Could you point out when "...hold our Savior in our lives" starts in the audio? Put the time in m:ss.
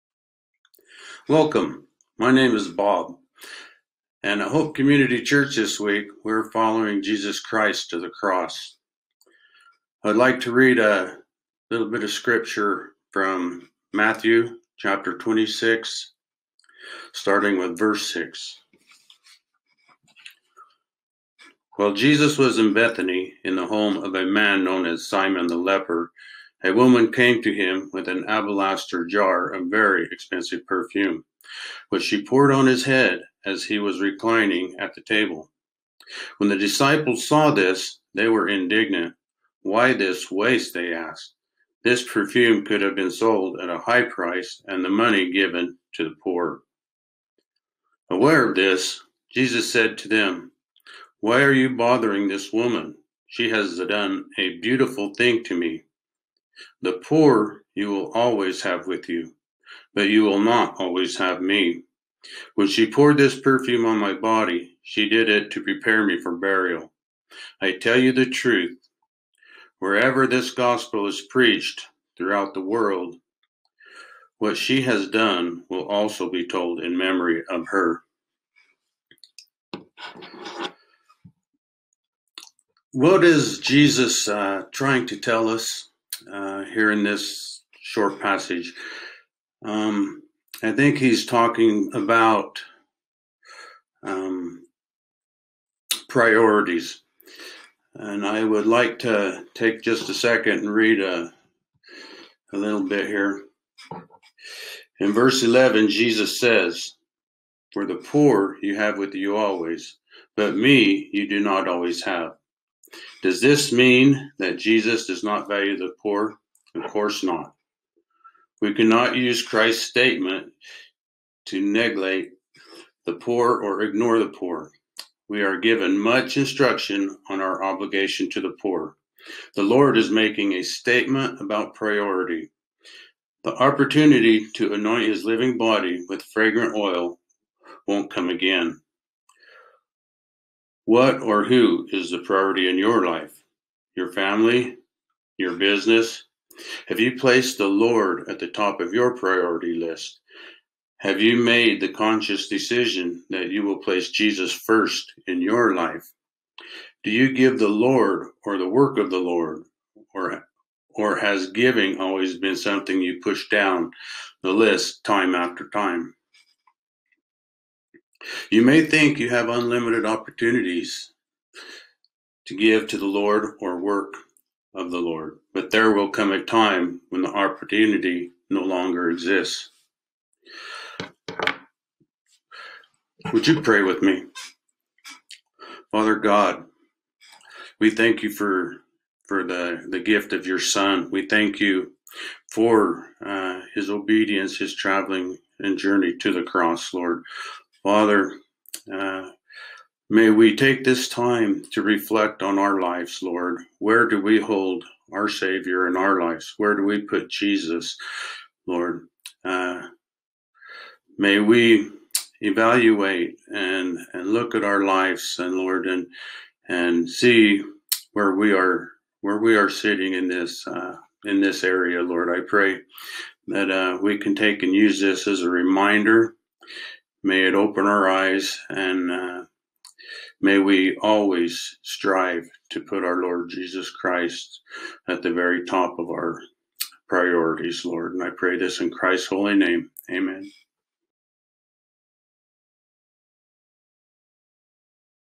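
3:24.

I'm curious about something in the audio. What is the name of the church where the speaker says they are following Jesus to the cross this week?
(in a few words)
Hope Community Church.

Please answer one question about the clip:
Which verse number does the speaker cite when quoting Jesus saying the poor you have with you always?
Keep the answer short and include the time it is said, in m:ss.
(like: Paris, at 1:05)
11, at 1:45.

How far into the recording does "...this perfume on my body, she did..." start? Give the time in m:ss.
1:03.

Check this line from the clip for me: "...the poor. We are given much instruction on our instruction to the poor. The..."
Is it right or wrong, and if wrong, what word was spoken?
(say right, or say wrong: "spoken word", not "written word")
wrong: "obligation", not "instruction".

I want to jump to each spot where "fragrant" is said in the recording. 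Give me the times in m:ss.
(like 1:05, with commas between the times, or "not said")
2:16.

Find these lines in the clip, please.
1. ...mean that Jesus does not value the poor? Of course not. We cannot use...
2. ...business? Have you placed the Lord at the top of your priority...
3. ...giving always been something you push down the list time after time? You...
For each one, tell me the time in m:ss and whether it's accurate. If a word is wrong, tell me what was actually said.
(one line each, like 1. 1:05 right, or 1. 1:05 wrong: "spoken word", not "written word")
1. 1:53 right
2. 2:25 right
3. 2:41 right.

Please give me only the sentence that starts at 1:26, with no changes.
uh, here in this short passage.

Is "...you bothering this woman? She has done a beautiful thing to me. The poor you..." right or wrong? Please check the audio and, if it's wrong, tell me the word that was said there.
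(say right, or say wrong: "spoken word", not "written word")
right.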